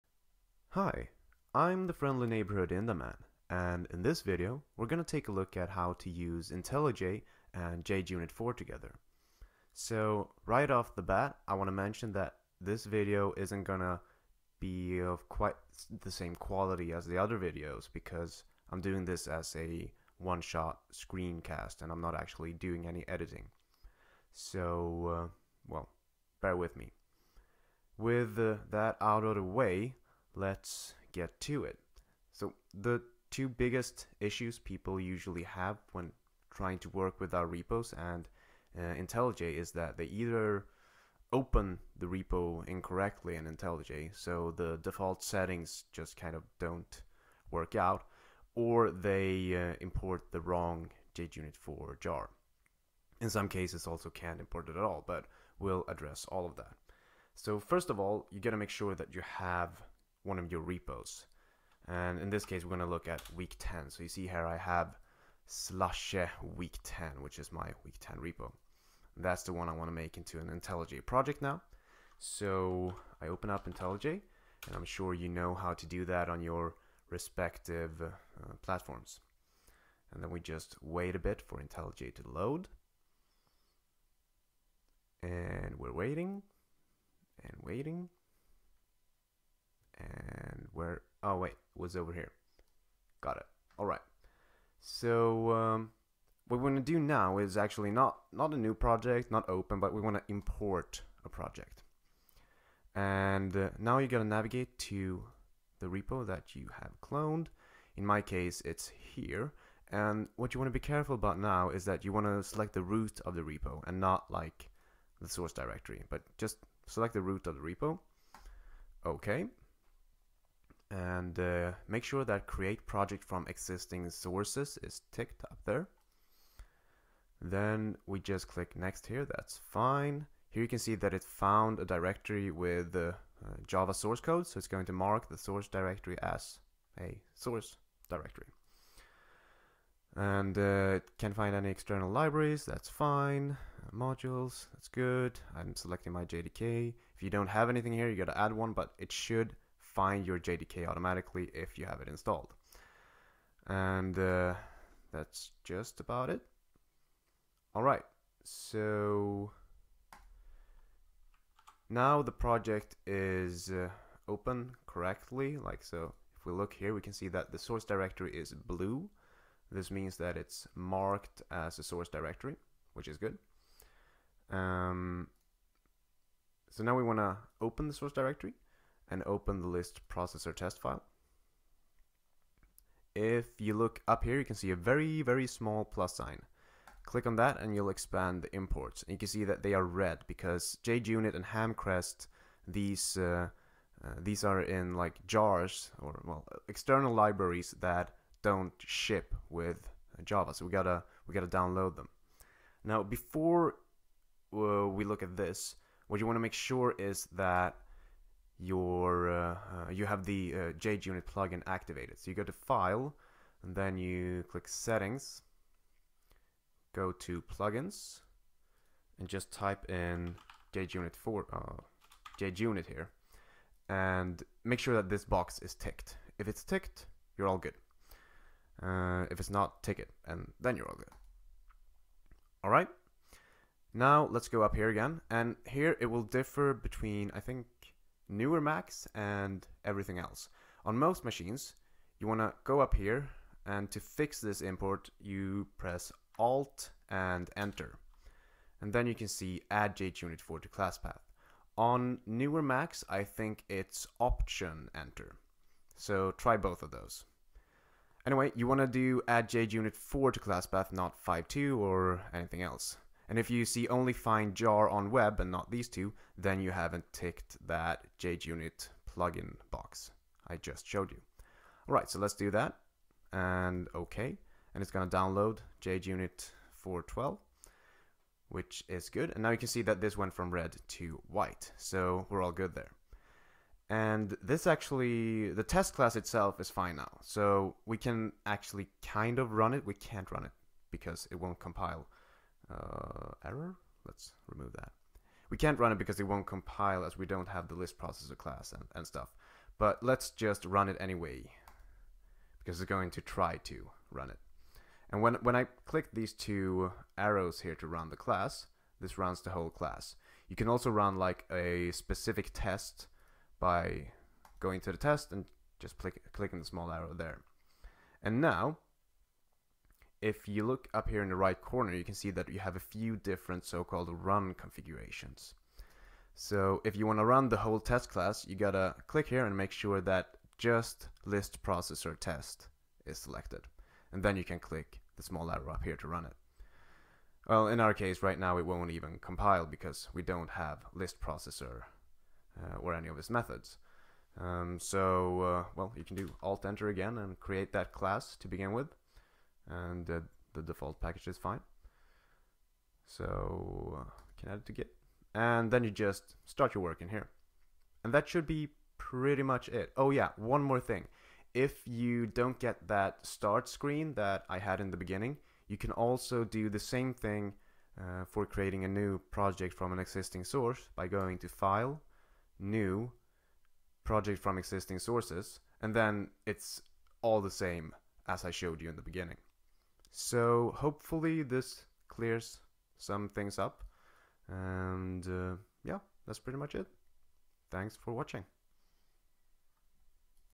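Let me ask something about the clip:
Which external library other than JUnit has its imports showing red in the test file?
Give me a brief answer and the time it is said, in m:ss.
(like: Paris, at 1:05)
Hamcrest, at 3:11.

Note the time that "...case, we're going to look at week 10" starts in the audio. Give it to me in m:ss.
1:02.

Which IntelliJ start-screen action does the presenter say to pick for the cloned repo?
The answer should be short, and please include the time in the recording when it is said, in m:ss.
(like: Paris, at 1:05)
Import a project, at 1:40.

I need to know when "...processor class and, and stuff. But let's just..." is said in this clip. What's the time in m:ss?
4:57.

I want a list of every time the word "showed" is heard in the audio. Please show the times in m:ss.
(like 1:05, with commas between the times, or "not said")
4:30, 6:18.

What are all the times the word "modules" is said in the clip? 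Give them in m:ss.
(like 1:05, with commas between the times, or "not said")
2:23.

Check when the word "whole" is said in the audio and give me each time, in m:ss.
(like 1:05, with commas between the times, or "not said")
5:09, 5:27.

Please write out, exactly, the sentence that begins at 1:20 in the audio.
And then we just wait a bit for IntelliJ to load.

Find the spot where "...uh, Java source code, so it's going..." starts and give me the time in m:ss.
2:12.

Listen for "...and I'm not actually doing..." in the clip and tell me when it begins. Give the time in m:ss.
0:21.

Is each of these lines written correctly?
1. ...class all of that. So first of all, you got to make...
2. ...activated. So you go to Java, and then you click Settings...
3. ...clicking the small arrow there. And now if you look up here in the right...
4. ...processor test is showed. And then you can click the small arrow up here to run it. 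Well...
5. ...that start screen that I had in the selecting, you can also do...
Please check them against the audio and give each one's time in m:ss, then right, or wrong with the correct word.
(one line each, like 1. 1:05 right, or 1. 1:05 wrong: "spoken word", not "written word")
1. 0:55 wrong: "address", not "class"
2. 3:31 wrong: "File", not "Java"
3. 5:16 right
4. 5:31 wrong: "selected", not "showed"
5. 6:02 wrong: "beginning", not "selecting".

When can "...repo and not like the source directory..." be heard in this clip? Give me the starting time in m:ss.
1:53.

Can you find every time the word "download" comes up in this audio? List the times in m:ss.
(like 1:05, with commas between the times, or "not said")
3:21, 4:35.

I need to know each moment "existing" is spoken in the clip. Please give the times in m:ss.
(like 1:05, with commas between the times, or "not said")
2:03, 6:09, 6:14.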